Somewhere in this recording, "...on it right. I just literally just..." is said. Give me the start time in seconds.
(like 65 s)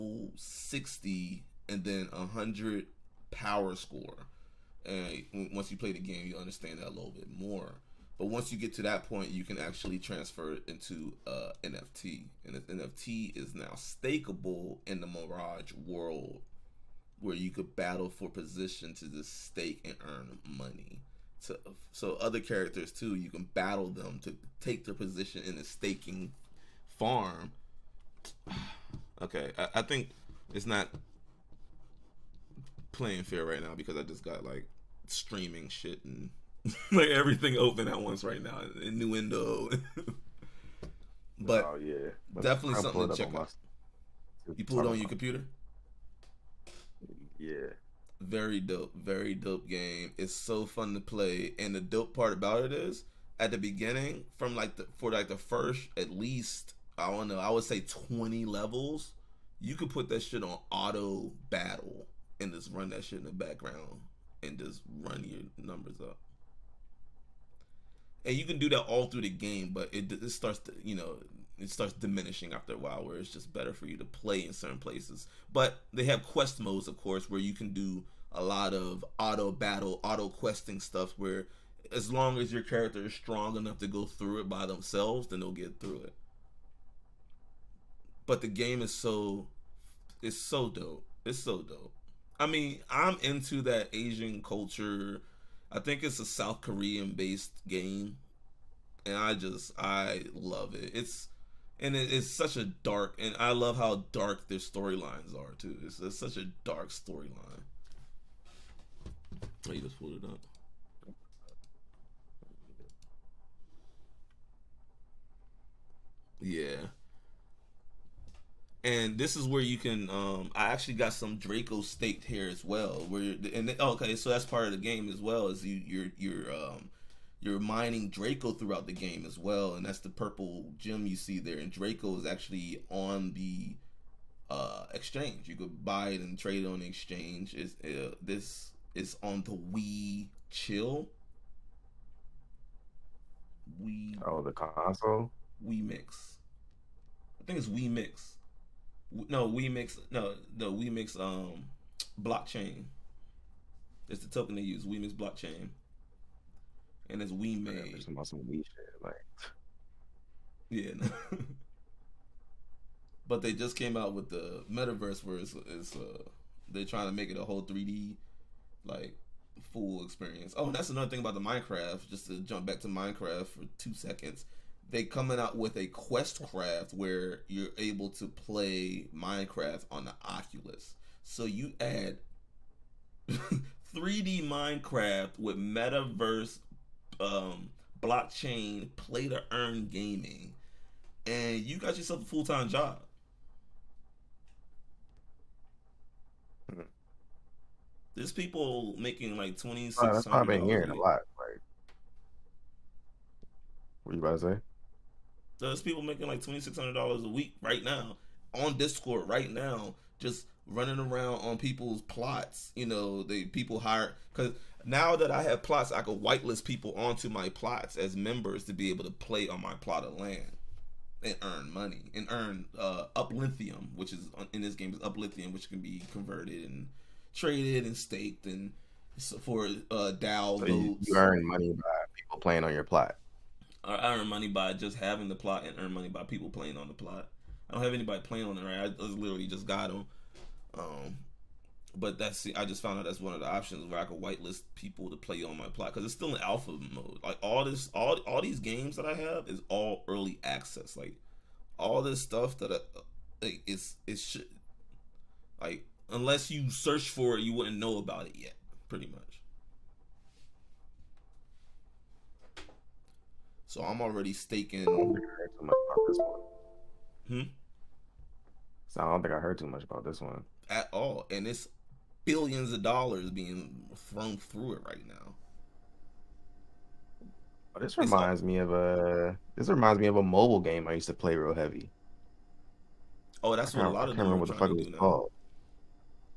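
238 s.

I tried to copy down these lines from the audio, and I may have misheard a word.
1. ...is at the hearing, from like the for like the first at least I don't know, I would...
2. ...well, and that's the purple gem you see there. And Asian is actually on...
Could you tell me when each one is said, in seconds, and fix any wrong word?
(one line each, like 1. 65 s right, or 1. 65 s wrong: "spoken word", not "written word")
1. 52 s wrong: "beginning", not "hearing"
2. 129 s wrong: "Draco", not "Asian".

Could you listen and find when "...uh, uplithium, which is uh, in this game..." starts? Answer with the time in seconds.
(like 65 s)
222 s.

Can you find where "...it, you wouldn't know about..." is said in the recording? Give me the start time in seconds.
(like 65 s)
257 s.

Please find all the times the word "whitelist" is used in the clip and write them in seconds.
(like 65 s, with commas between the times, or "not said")
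216 s, 244 s.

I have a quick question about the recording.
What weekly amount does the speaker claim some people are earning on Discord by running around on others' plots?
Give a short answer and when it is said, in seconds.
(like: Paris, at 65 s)
$2,600, at 206 s.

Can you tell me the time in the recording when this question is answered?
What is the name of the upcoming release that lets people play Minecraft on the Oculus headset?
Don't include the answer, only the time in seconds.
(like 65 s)
175 s.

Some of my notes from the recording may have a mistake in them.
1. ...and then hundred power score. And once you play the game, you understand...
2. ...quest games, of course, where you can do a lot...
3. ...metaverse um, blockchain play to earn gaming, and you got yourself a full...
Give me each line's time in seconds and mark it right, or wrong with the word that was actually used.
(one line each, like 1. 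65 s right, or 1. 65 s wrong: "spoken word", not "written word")
1. 1 s right
2. 76 s wrong: "modes", not "games"
3. 185 s right.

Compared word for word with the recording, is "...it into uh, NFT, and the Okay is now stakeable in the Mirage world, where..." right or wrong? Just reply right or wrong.
wrong.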